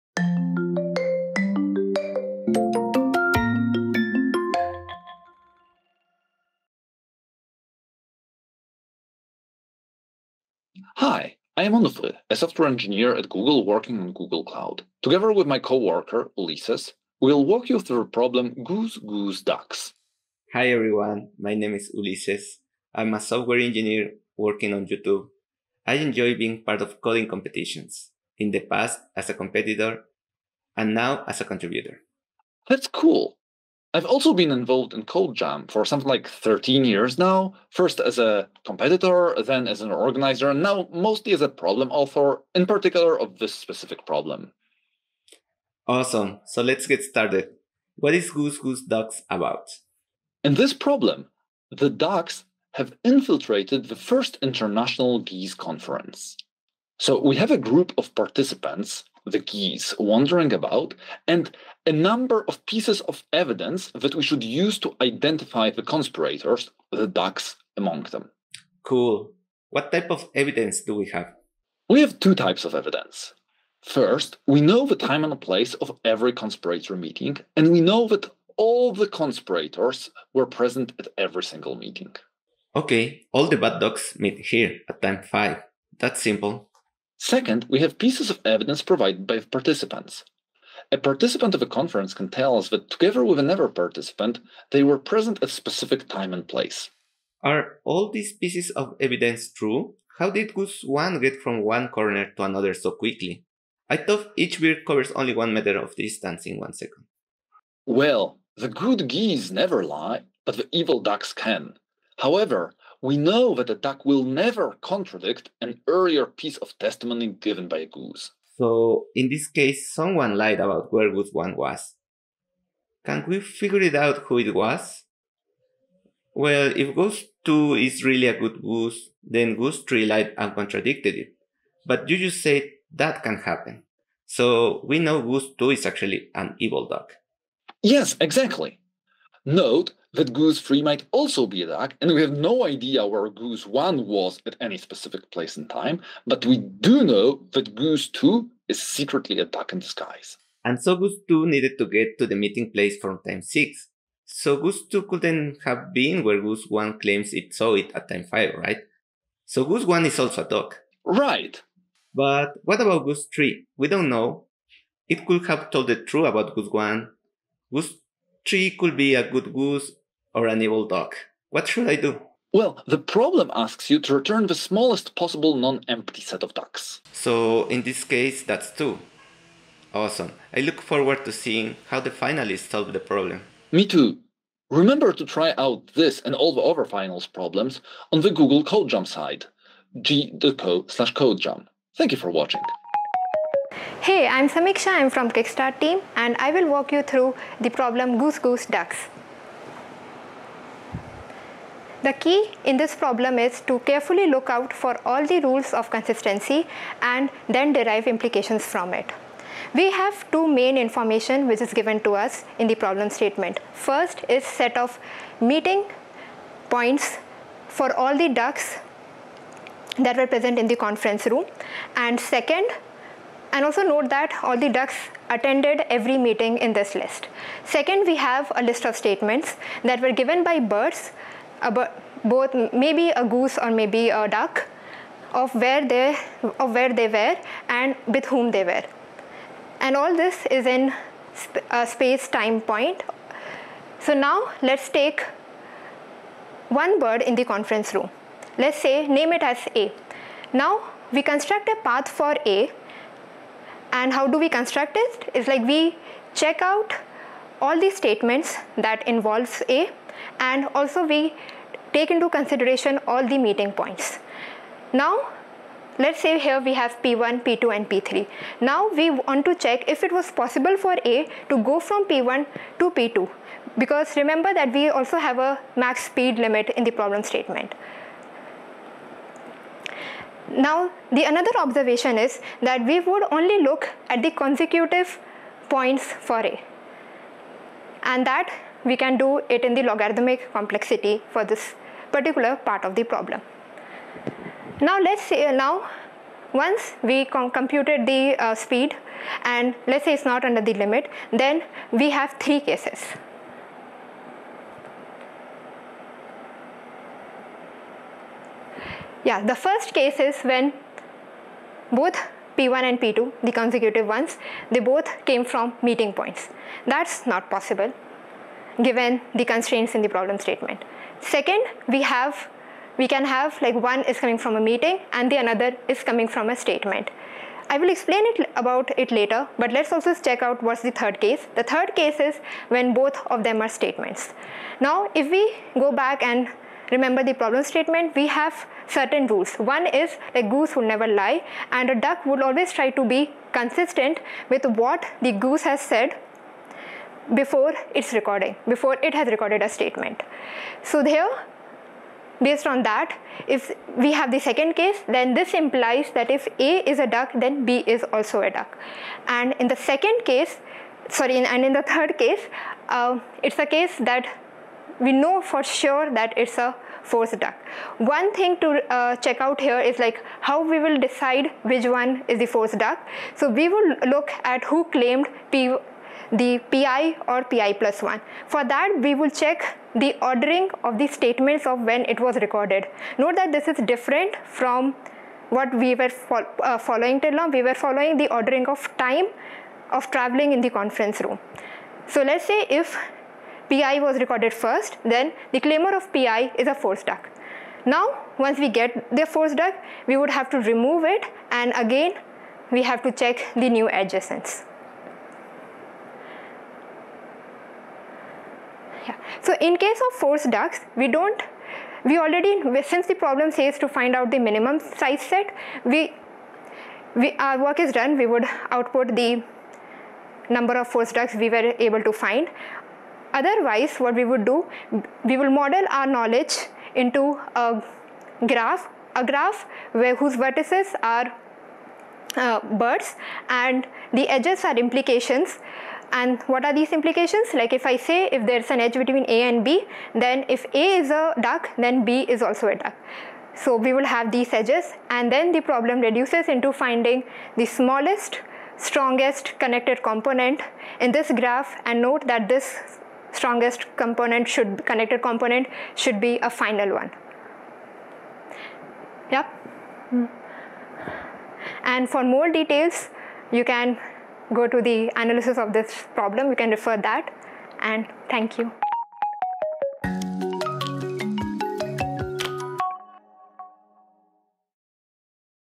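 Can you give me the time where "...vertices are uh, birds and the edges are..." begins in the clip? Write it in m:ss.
7:10.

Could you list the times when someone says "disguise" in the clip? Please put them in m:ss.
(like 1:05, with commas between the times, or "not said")
2:29.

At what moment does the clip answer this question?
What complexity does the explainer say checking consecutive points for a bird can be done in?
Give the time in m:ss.
4:49.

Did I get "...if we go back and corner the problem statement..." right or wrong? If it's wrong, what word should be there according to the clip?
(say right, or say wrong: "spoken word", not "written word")
wrong: "remember", not "corner".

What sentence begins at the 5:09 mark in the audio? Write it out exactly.
Yeah, the first case is when both P1 and P2, the consecutive ones, they both came from meeting points.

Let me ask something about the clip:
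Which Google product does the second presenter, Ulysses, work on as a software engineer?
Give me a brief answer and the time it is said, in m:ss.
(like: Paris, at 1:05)
YouTube, at 0:24.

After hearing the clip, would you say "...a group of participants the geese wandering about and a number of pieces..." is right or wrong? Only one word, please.
right.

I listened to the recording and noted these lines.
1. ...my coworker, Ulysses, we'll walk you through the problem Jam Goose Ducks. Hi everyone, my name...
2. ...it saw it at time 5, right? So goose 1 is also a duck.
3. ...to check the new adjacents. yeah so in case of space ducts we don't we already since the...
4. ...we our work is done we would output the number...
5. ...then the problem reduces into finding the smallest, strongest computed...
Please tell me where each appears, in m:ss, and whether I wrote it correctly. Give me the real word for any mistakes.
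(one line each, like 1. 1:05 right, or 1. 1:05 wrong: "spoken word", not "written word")
1. 0:15 wrong: "Goose", not "Jam"
2. 2:37 right
3. 6:43 wrong: "force", not "space"
4. 6:57 right
5. 7:25 wrong: "connected", not "computed".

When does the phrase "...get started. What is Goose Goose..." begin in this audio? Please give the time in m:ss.
0:46.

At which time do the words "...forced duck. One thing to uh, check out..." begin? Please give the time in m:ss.
6:07.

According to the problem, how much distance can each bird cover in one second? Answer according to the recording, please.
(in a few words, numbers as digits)
1 meter.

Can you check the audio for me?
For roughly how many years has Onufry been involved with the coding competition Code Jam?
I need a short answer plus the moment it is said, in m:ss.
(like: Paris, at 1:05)
13 years, at 0:36.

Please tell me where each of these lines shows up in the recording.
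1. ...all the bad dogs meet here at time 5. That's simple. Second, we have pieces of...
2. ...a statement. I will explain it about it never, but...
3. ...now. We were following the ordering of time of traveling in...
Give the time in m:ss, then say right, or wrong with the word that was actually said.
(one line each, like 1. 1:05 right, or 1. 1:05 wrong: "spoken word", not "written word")
1. 1:23 right
2. 5:26 wrong: "later", not "never"
3. 6:27 right.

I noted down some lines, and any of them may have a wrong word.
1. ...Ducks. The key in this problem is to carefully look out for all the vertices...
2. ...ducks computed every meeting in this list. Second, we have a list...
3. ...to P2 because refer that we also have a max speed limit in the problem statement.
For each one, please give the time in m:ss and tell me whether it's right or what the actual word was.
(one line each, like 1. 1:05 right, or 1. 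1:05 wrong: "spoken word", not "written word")
1. 3:18 wrong: "rules", not "vertices"
2. 3:44 wrong: "attended", not "computed"
3. 4:32 wrong: "remember", not "refer".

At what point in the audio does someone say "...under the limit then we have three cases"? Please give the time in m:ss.
5:00.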